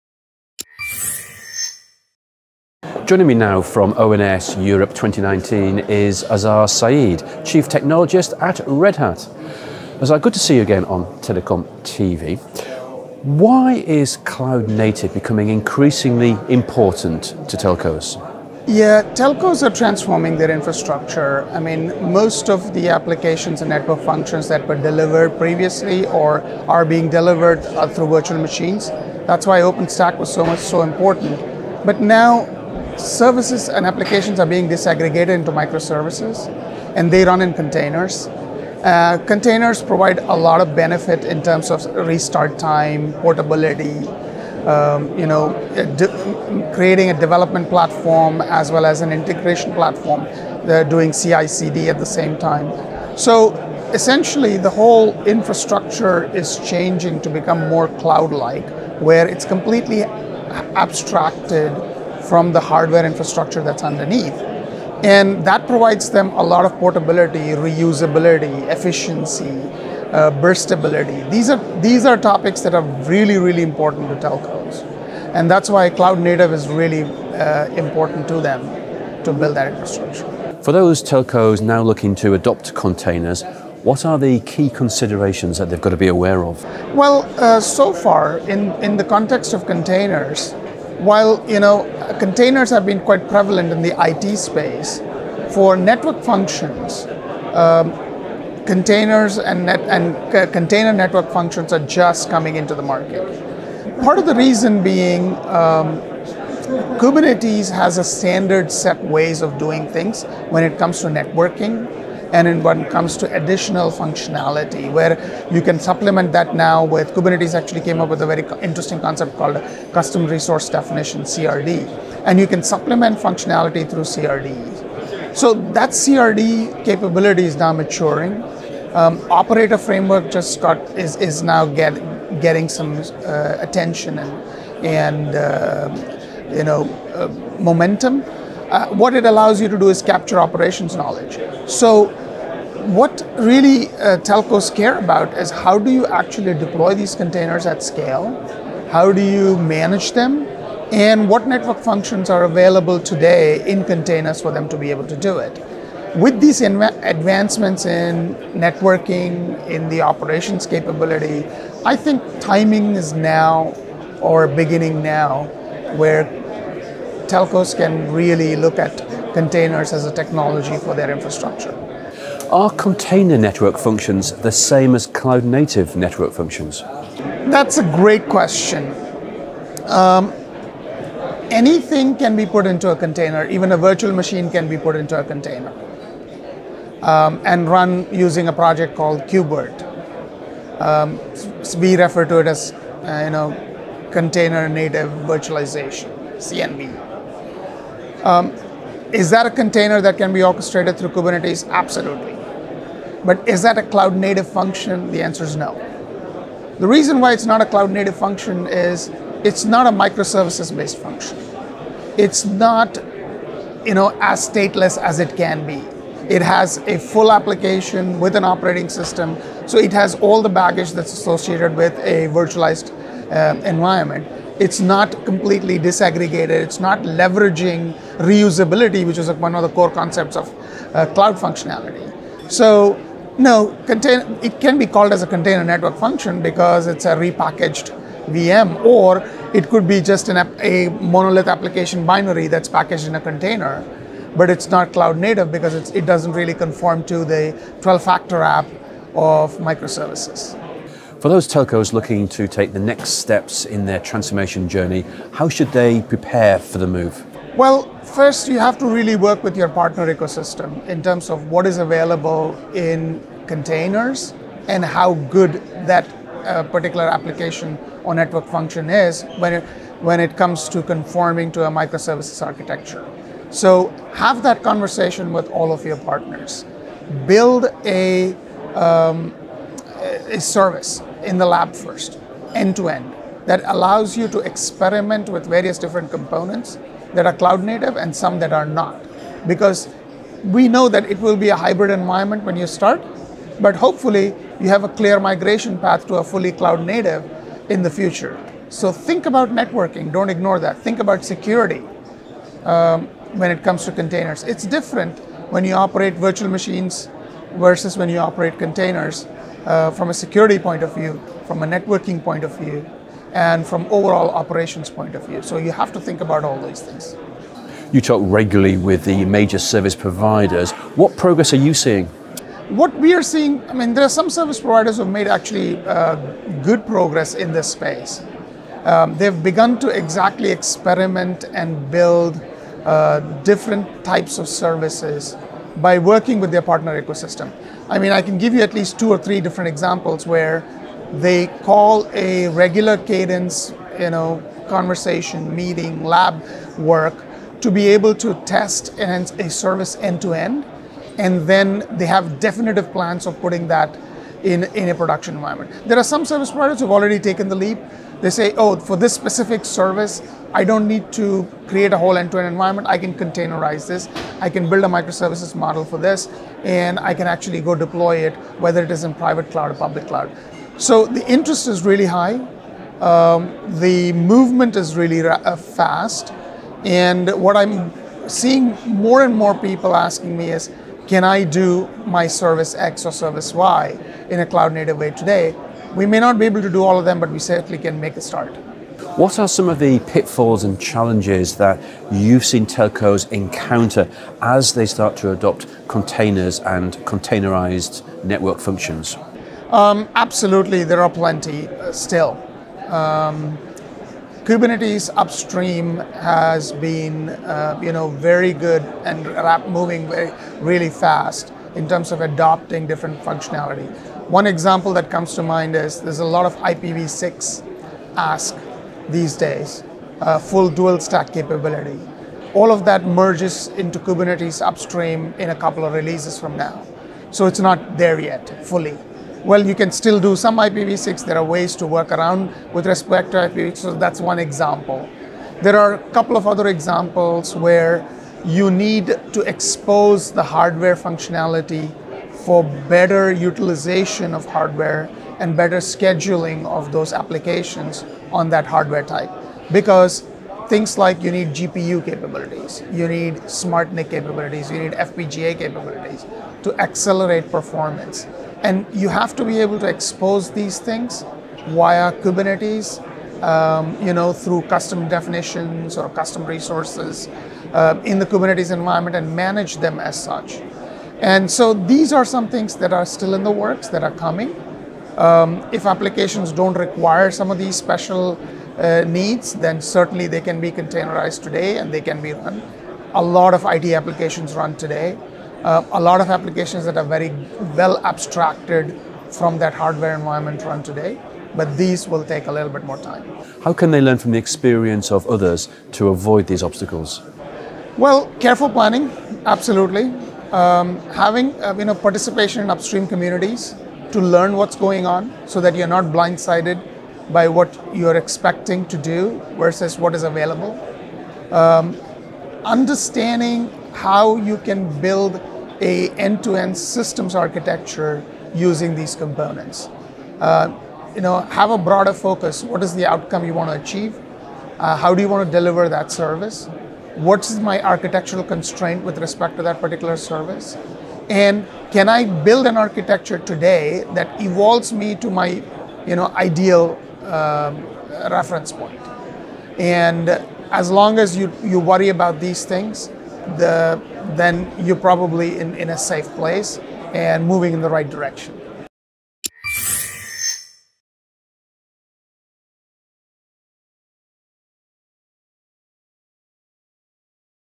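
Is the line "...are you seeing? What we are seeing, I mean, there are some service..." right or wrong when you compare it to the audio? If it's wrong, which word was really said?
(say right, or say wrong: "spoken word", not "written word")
right.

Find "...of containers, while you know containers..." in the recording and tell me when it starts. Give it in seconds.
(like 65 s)
89 s.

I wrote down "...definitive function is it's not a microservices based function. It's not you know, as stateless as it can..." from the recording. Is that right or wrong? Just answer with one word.
wrong.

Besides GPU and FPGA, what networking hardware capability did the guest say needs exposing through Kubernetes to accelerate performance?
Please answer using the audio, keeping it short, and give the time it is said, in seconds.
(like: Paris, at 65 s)
smart NIC, at 453 s.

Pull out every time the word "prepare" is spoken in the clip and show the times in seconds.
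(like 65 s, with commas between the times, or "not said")
256 s.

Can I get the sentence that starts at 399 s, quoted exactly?
Um, absolutely, there are plenty uh, still.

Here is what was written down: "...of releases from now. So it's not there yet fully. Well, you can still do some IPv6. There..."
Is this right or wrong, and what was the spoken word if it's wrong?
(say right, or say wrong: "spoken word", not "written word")
right.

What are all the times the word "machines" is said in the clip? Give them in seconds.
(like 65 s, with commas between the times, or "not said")
28 s, 184 s, 306 s.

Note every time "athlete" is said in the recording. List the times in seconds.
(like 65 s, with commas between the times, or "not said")
not said.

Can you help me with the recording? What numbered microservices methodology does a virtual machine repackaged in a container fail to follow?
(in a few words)
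12 factor app.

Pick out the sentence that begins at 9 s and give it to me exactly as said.
Azhar, good to see you again on Telecom TV.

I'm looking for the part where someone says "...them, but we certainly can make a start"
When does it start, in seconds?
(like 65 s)
387 s.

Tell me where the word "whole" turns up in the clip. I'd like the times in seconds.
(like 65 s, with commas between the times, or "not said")
54 s, 361 s.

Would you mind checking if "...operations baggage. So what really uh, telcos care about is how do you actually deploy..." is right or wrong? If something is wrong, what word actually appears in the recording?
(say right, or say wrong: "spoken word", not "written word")
wrong: "knowledge", not "baggage".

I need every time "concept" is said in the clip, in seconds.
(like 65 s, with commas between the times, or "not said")
118 s, 229 s.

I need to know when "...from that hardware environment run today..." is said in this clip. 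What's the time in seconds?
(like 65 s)
489 s.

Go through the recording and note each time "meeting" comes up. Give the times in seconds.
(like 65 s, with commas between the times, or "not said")
345 s.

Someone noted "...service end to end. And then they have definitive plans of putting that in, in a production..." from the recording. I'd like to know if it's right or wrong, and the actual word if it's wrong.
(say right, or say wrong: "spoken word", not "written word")
right.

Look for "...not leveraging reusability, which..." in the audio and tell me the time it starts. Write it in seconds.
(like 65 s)
226 s.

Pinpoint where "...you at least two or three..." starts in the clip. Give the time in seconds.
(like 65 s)
338 s.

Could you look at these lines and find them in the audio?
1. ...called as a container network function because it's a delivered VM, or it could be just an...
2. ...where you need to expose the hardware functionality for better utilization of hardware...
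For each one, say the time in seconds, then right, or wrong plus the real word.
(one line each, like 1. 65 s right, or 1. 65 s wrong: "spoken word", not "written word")
1. 234 s wrong: "repackaged", not "delivered"
2. 437 s right.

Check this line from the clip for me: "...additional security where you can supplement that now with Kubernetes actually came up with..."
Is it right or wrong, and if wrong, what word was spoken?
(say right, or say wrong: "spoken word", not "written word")
wrong: "functionality", not "security".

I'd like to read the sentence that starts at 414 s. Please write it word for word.
One example that comes to mind is there's a lot of IPv6 ask these days, uh, full dual stack capability.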